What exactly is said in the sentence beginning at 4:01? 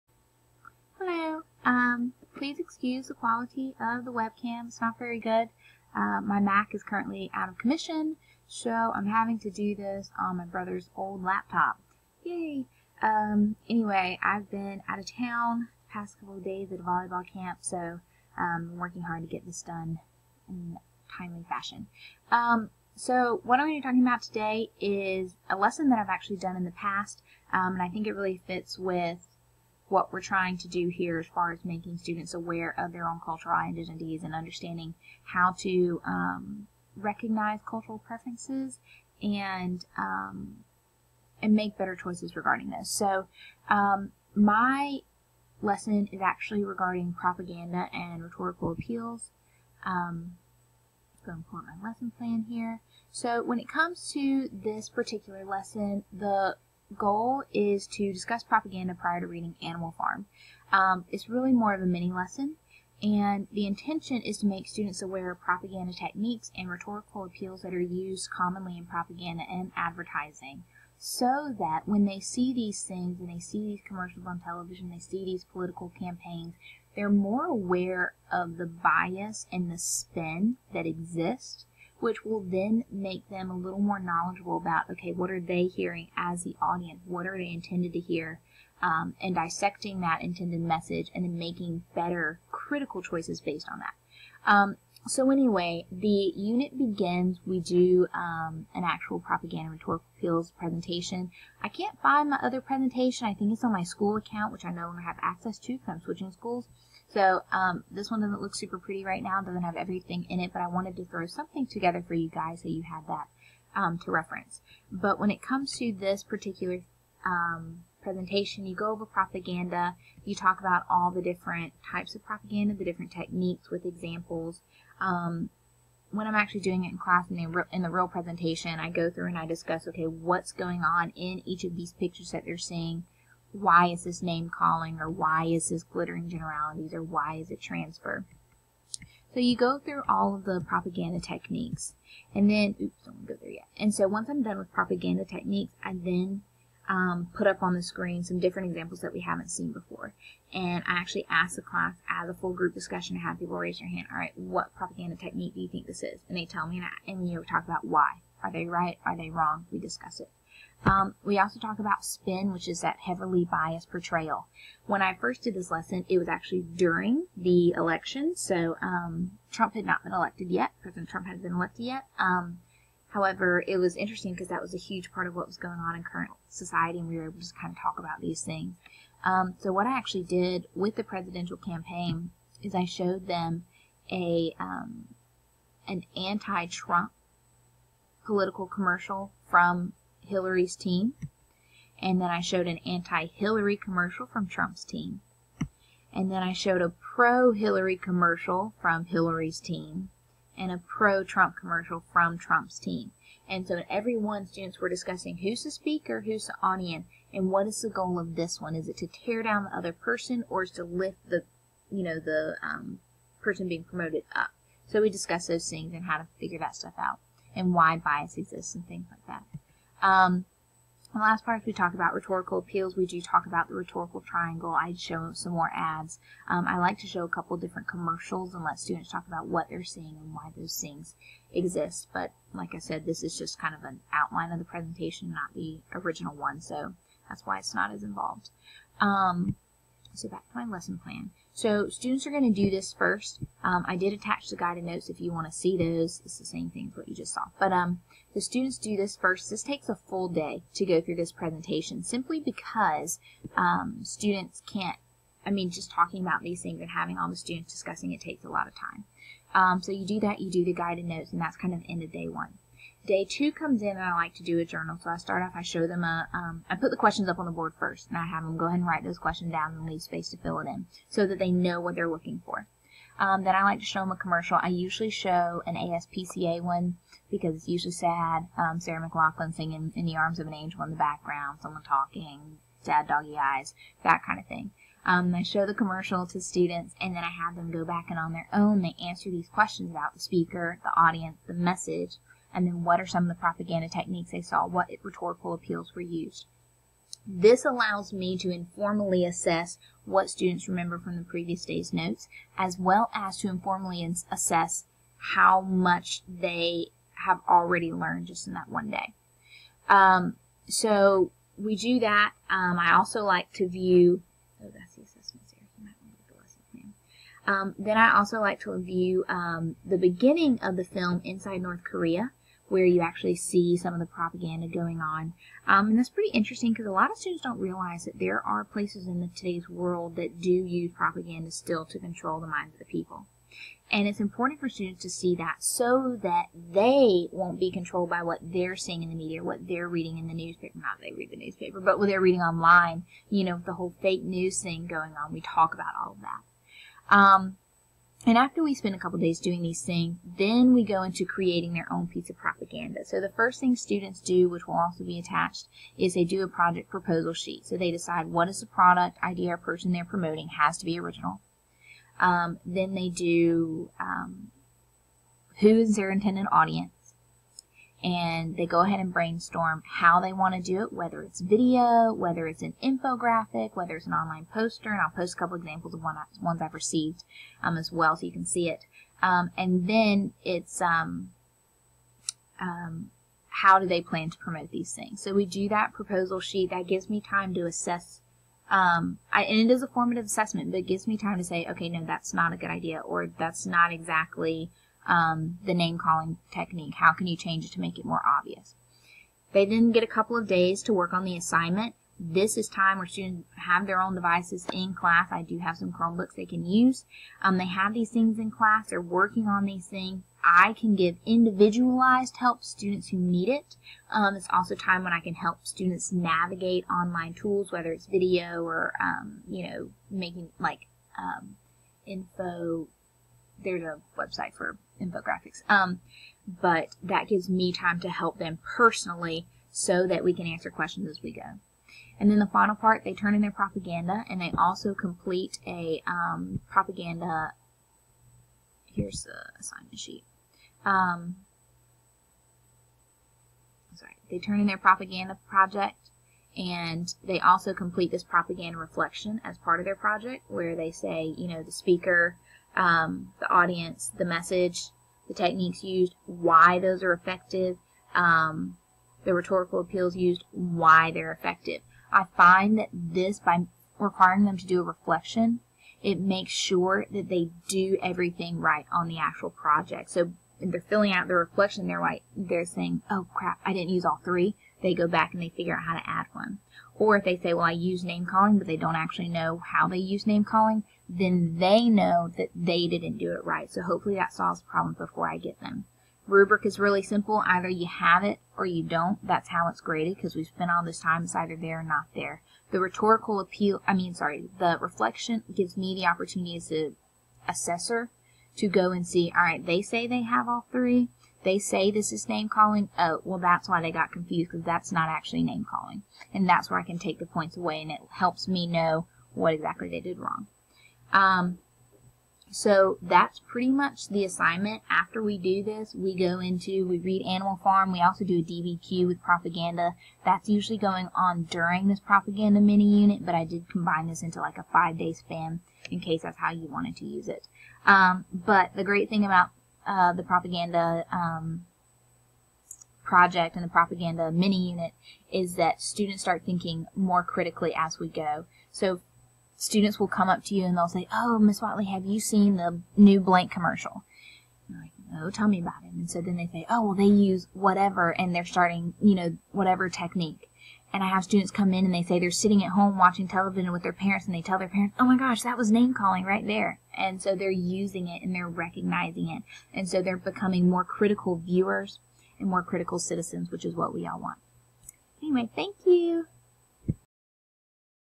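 So students are going to do this first.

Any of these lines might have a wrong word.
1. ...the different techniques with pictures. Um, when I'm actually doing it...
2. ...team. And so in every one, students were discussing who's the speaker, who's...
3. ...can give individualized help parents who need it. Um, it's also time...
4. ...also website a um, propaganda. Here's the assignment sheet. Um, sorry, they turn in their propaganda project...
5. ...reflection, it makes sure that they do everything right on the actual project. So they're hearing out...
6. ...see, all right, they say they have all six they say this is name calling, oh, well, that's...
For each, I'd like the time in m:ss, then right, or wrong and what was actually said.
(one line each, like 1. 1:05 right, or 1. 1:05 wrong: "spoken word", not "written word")
1. 2:02 wrong: "examples", not "pictures"
2. 3:22 right
3. 6:50 wrong: "students", not "parents"
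4. 7:14 wrong: "complete", not "website"
5. 7:44 wrong: "filling", not "hearing"
6. 8:19 wrong: "three", not "six".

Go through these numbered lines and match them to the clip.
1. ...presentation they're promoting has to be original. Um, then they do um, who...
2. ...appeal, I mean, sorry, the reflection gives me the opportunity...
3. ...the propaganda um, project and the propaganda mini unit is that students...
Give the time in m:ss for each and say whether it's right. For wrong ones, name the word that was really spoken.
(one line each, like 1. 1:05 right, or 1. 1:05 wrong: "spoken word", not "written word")
1. 5:59 wrong: "person", not "presentation"
2. 8:13 right
3. 8:50 right.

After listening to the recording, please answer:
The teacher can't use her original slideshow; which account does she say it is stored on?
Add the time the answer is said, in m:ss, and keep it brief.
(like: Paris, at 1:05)
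School account, at 1:43.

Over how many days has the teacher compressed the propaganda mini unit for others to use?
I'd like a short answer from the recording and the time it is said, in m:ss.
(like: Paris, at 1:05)
5, at 8:44.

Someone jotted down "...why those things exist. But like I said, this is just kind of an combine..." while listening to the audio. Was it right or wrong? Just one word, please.
wrong.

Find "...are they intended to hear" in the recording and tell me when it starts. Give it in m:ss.
1:27.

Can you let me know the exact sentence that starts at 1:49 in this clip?
doesn't have everything in it, but I wanted to throw something together for you guys so you have that um, to reference.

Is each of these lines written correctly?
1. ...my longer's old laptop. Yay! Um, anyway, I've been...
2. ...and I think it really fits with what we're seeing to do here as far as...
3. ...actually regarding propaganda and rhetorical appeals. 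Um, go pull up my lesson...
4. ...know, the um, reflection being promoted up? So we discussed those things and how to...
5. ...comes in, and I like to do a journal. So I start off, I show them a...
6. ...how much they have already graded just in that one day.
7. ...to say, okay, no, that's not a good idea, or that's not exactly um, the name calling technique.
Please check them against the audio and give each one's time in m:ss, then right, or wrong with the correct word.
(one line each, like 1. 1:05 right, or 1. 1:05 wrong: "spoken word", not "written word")
1. 0:10 wrong: "brother", not "longer"
2. 0:27 wrong: "trying", not "seeing"
3. 0:46 right
4. 3:32 wrong: "person", not "reflection"
5. 4:23 right
6. 5:05 wrong: "learned", not "graded"
7. 6:31 right.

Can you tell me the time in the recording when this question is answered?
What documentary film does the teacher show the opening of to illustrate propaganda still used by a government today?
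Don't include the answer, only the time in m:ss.
5:21.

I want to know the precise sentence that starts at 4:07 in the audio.
But um, the students do this first.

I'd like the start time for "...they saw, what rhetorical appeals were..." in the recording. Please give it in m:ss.
4:54.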